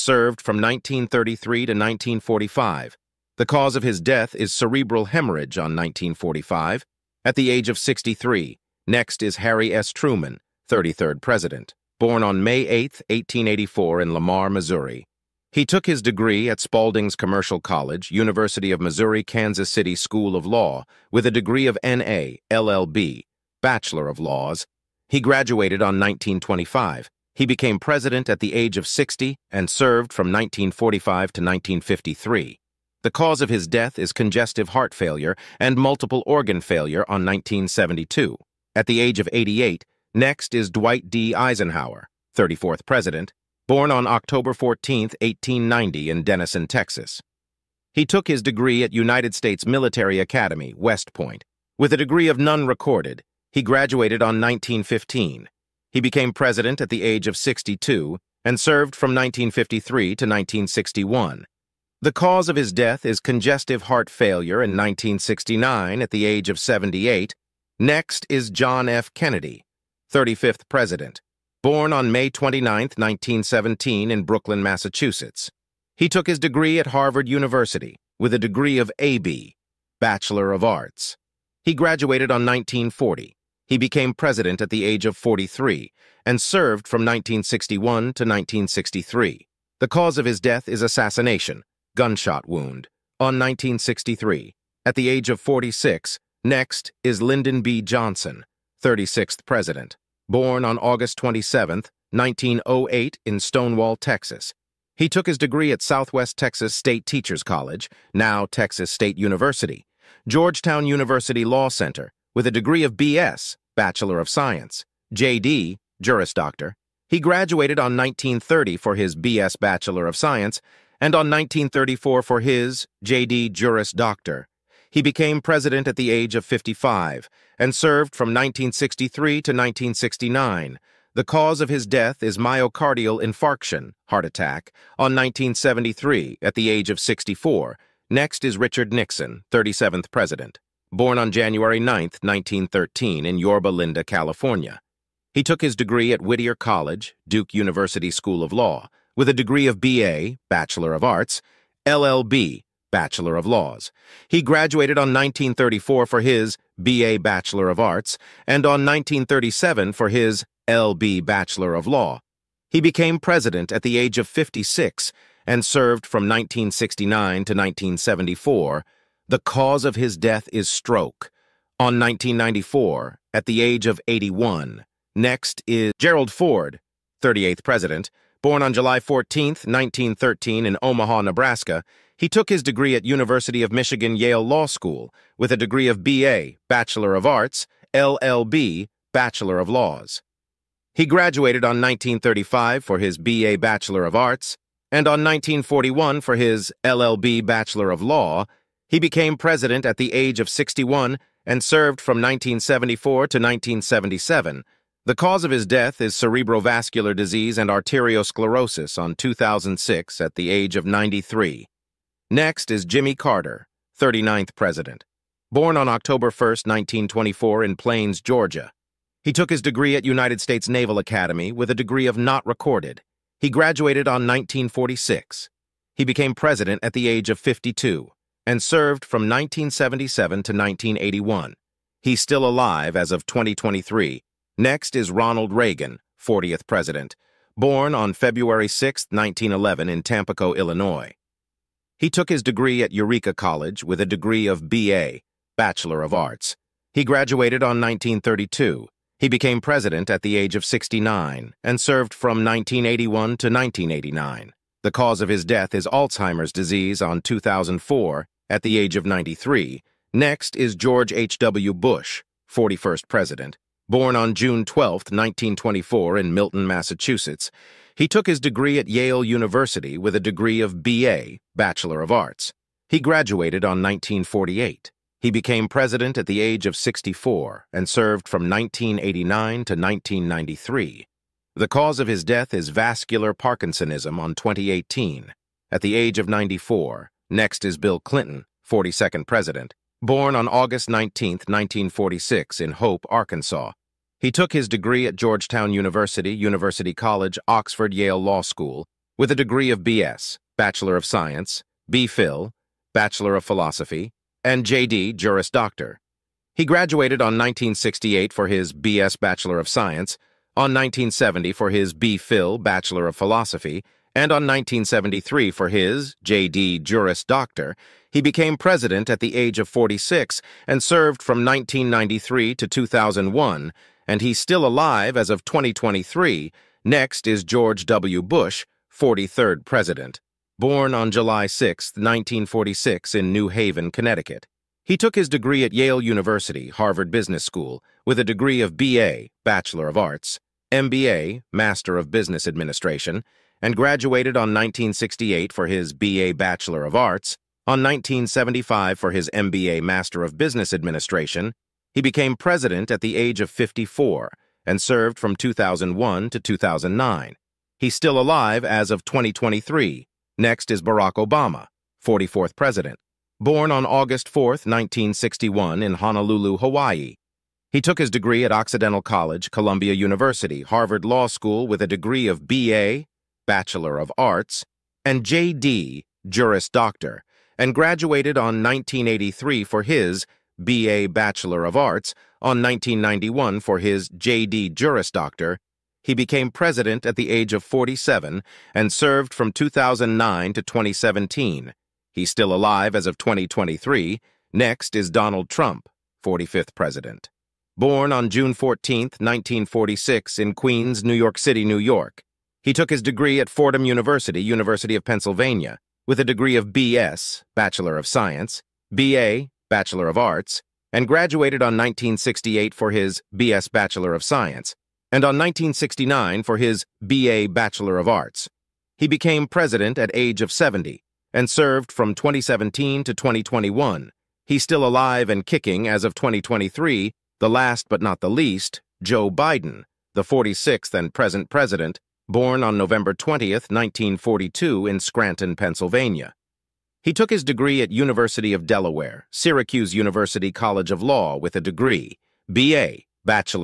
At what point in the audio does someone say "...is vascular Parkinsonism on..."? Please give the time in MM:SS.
04:42.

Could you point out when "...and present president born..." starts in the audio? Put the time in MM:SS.
07:10.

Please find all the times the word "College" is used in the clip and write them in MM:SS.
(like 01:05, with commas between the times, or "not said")
00:17, 01:47, 02:26, 04:03, 04:56, 06:09, 07:20.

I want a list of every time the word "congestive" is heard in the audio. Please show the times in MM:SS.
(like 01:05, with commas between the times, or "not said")
00:34, 01:03.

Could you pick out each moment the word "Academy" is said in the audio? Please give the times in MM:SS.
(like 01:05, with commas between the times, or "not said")
00:50, 03:40.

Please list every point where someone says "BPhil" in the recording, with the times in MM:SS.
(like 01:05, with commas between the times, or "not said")
05:01, 05:11.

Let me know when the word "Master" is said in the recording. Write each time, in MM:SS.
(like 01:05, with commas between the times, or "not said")
05:41, 05:49.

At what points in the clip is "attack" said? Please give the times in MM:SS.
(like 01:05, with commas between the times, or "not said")
02:14.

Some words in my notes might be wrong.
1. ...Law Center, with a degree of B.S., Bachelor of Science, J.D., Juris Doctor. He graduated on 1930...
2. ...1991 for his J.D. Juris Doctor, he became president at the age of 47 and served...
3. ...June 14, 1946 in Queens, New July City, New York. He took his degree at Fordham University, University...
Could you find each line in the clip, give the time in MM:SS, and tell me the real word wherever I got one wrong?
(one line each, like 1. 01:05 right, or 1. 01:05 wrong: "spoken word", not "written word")
1. 01:51 right
2. 06:22 right
3. 06:38 wrong: "York", not "July".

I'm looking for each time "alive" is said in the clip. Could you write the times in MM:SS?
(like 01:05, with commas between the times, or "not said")
03:52, 05:24, 05:58, 06:32, 07:04.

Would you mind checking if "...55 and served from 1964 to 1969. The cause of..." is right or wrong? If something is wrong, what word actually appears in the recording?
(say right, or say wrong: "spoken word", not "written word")
wrong: "1963", not "1964".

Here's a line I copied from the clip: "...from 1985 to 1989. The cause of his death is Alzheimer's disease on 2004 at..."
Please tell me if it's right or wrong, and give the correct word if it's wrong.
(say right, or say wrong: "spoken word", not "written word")
wrong: "1981", not "1985".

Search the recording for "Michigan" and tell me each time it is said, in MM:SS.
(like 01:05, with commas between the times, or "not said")
03:03.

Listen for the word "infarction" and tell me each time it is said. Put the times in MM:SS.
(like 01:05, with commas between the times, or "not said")
02:13.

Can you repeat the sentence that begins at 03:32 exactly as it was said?
Next is Jimmy Carter, 39th president.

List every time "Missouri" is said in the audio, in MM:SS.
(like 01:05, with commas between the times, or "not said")
00:14, 00:18.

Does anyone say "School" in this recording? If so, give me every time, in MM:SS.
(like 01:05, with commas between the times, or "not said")
00:19, 02:28, 03:04, 04:58, 05:37, 06:11.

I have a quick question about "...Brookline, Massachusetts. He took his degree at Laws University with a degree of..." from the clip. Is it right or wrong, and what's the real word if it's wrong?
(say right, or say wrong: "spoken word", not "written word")
wrong: "Harvard", not "Laws".